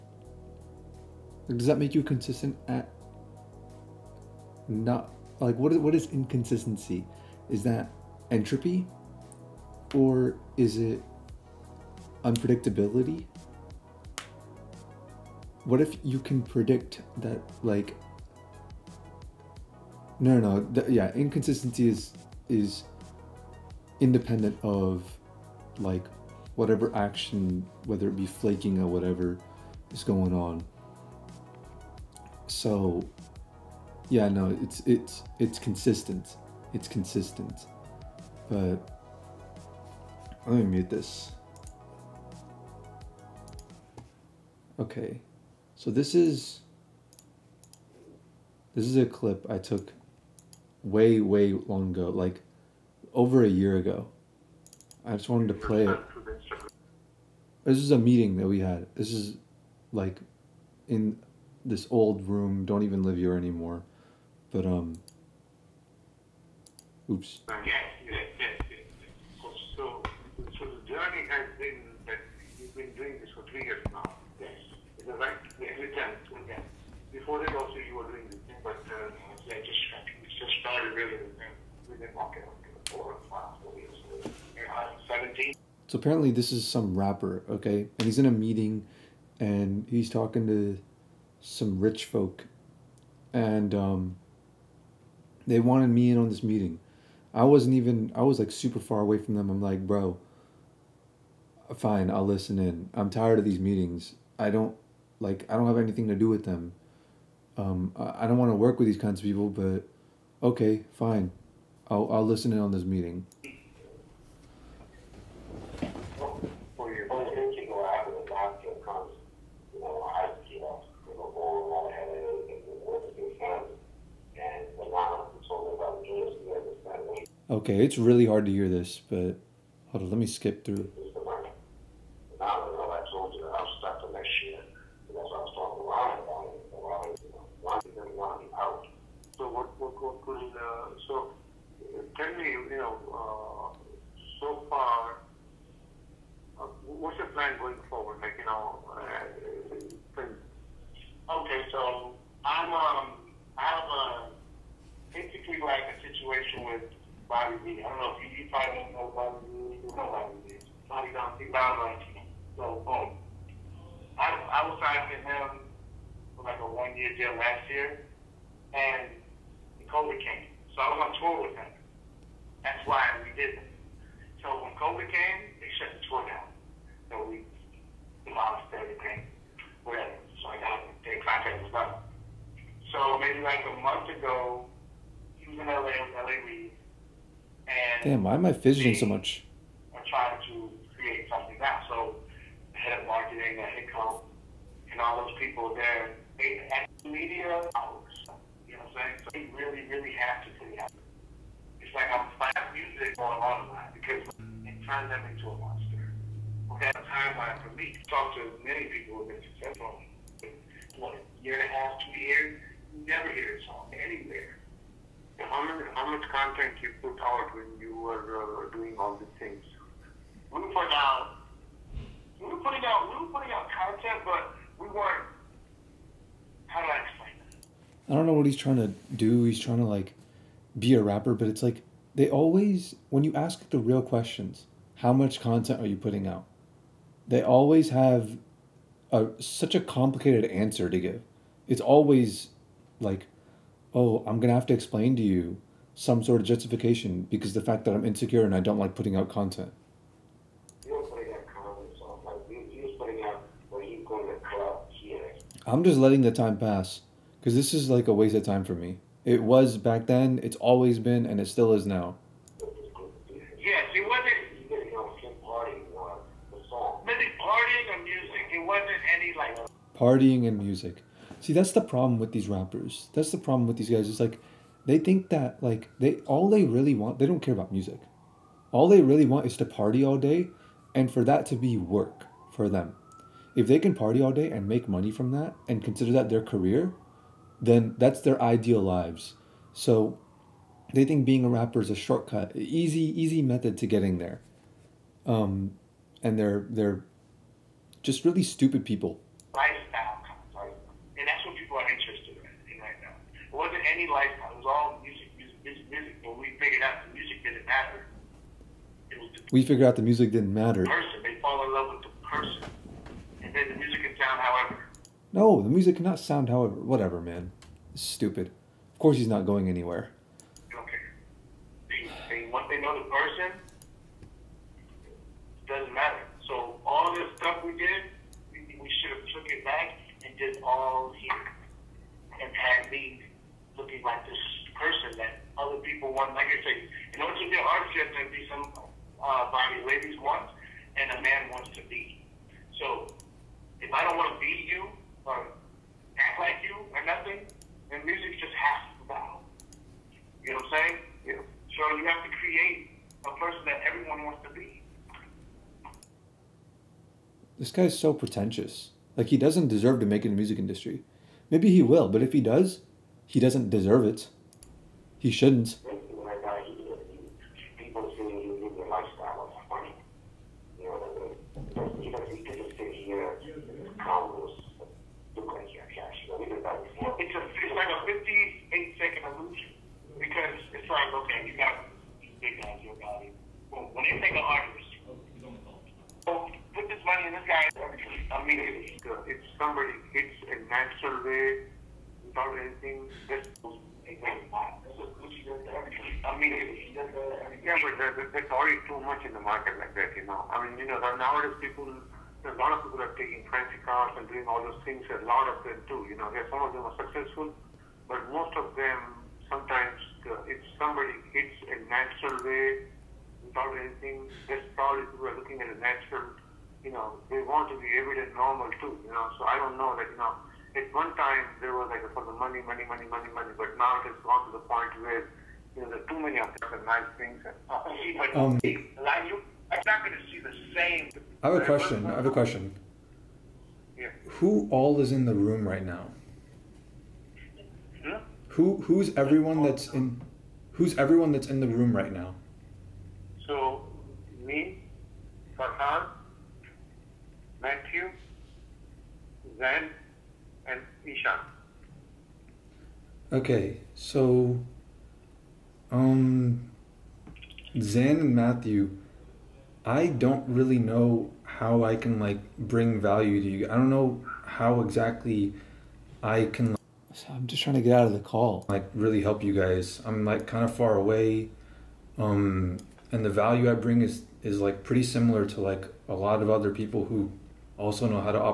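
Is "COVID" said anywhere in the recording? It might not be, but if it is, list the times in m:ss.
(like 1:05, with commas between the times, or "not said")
2:49, 2:54.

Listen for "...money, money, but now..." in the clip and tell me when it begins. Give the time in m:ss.
7:03.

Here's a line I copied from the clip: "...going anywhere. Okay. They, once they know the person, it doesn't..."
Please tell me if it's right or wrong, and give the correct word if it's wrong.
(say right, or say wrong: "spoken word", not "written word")
right.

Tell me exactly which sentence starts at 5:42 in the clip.
So if I don't want to be you or act like you or nothing, then music just has to bow.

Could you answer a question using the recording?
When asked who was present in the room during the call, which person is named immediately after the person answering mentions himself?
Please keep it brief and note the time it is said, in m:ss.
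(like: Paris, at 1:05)
Farhan, at 7:25.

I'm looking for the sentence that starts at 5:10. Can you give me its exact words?
Person say the music can sound however.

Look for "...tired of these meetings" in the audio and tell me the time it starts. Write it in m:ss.
1:43.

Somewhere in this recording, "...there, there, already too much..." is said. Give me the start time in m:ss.
6:37.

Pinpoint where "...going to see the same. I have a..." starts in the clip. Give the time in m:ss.
7:10.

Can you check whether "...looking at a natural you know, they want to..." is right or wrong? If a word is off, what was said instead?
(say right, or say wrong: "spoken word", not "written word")
right.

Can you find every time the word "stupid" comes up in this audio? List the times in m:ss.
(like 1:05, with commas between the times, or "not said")
4:58, 5:18.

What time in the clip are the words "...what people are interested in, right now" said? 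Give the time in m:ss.
5:01.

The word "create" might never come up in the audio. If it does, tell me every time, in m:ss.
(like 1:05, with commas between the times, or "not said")
3:11, 5:52.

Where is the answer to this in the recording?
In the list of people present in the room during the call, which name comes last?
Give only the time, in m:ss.
7:31.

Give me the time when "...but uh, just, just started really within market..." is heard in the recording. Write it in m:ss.
1:18.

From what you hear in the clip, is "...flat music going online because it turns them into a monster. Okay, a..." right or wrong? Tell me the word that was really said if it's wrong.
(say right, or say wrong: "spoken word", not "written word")
right.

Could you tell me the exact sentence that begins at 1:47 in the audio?
Um, I, I don't want to work with these kinds of people, but okay, fine.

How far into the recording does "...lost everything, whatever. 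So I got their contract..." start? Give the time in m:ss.
2:58.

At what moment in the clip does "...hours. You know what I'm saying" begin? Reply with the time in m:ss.
3:17.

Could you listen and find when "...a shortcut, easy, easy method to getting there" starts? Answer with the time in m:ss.
4:51.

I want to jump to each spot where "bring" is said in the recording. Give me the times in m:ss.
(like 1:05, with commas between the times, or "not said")
7:42, 7:53.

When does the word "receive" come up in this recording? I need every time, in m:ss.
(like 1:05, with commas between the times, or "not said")
not said.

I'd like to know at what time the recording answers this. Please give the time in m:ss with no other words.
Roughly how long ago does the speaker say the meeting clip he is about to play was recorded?
0:53.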